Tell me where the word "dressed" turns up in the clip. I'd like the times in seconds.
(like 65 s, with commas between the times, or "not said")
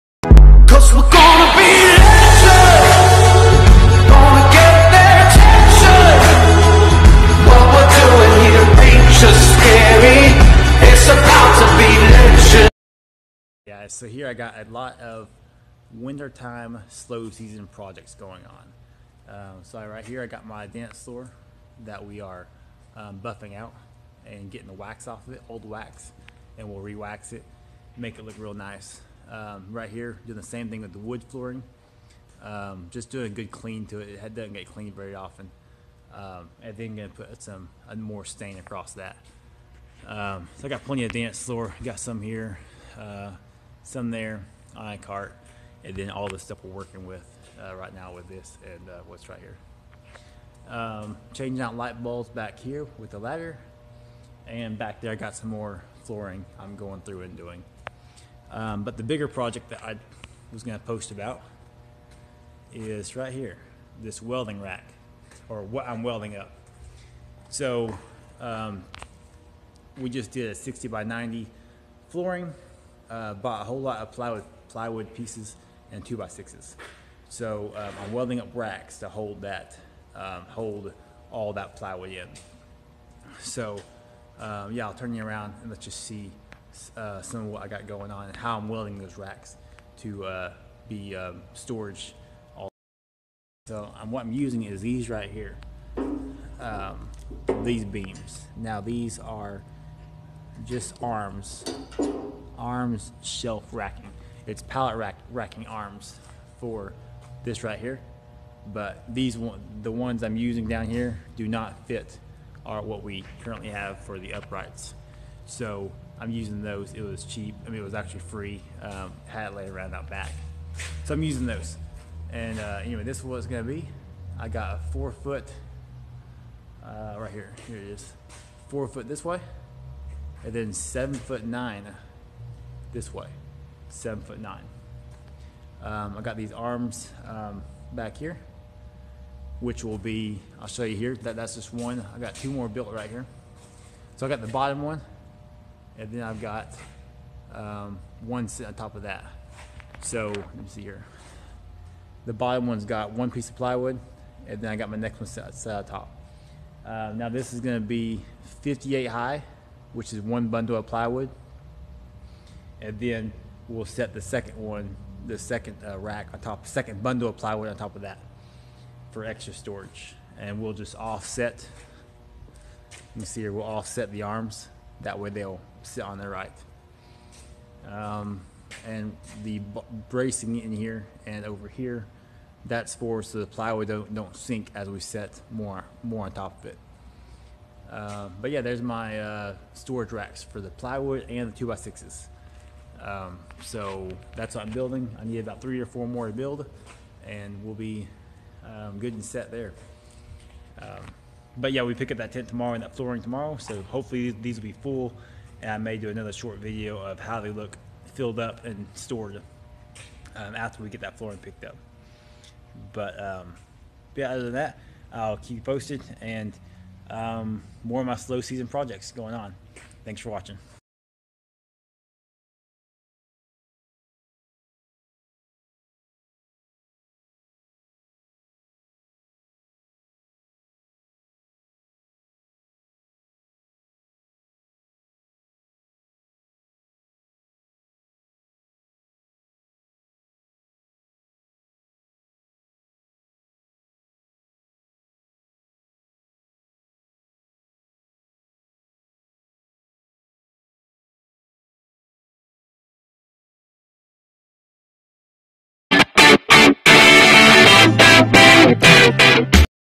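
not said.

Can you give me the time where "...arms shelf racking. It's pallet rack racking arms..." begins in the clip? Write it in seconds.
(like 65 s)
102 s.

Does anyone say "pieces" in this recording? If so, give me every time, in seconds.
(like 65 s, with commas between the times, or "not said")
75 s, 153 s.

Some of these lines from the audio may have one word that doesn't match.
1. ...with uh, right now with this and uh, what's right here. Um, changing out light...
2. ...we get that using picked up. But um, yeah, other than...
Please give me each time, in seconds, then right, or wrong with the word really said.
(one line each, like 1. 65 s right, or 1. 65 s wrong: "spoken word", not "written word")
1. 47 s right
2. 210 s wrong: "flooring", not "using".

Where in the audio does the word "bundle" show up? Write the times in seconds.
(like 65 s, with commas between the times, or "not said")
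160 s, 167 s.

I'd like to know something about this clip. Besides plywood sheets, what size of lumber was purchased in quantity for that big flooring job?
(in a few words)
2x6.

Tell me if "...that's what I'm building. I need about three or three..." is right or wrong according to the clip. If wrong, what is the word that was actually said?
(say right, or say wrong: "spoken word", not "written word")
wrong: "four", not "three".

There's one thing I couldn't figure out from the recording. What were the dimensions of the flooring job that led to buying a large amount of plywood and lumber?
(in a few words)
60 by 90.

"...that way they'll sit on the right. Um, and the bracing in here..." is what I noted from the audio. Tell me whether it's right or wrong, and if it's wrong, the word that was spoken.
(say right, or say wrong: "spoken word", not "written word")
right.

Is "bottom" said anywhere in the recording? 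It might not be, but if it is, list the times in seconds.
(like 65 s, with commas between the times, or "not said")
144 s, 152 s.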